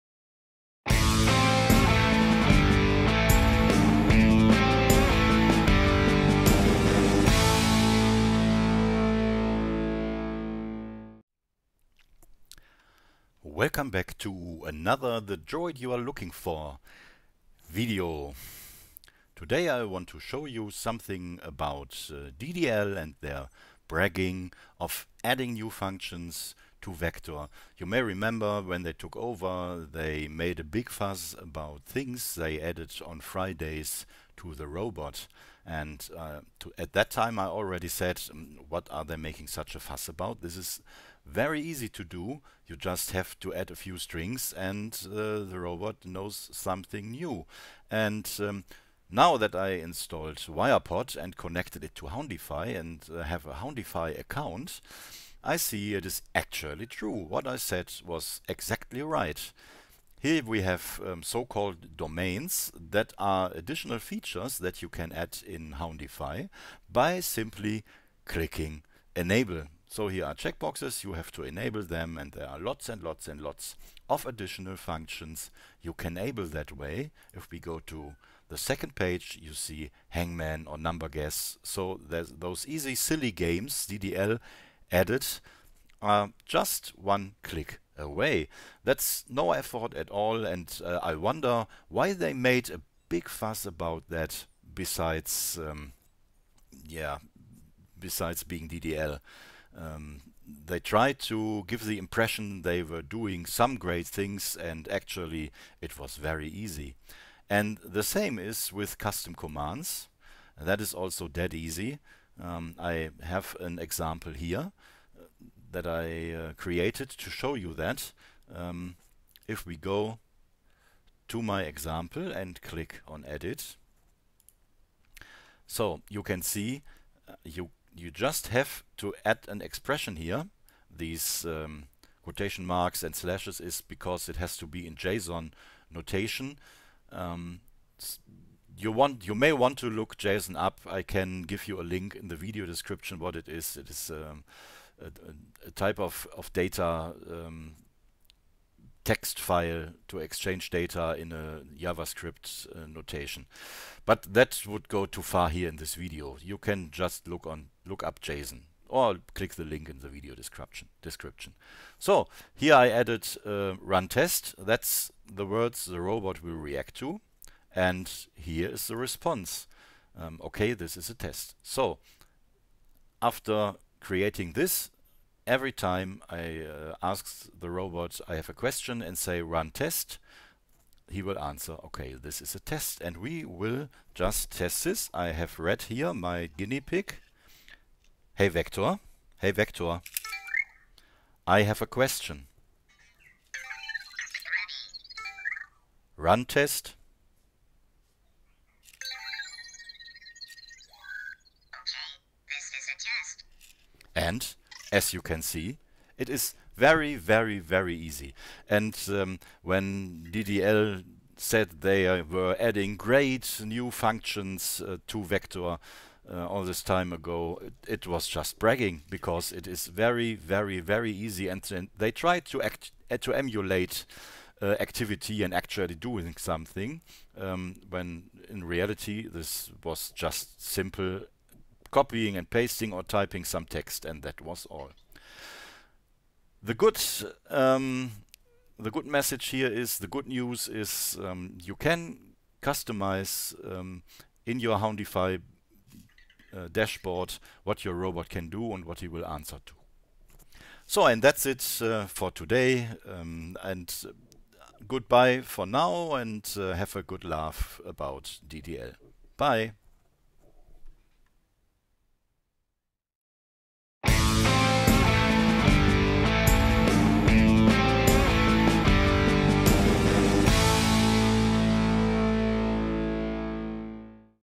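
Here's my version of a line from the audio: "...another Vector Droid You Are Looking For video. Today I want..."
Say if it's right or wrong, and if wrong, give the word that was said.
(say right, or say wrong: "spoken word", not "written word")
wrong: "The", not "Vector".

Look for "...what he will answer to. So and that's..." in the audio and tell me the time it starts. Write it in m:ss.
4:08.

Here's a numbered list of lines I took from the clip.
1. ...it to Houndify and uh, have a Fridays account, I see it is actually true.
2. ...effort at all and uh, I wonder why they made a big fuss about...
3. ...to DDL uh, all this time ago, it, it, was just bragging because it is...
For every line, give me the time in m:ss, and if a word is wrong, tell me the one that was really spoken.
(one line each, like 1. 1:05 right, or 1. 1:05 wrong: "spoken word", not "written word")
1. 0:51 wrong: "Houndify", not "Fridays"
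2. 1:29 right
3. 3:35 wrong: "Vector", not "DDL".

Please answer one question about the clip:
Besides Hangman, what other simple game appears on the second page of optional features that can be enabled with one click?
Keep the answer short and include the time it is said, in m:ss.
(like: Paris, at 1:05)
Number Guess, at 1:20.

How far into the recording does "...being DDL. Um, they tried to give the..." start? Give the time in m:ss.
1:38.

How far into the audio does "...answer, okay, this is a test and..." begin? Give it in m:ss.
3:01.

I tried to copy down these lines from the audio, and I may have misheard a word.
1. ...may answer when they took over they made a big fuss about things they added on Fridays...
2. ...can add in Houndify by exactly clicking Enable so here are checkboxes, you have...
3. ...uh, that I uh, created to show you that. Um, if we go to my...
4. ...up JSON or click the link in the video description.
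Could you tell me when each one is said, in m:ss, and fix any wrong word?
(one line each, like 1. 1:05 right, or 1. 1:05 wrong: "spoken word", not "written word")
1. 0:27 wrong: "remember", not "answer"
2. 1:04 wrong: "simply", not "exactly"
3. 1:55 right
4. 2:38 right.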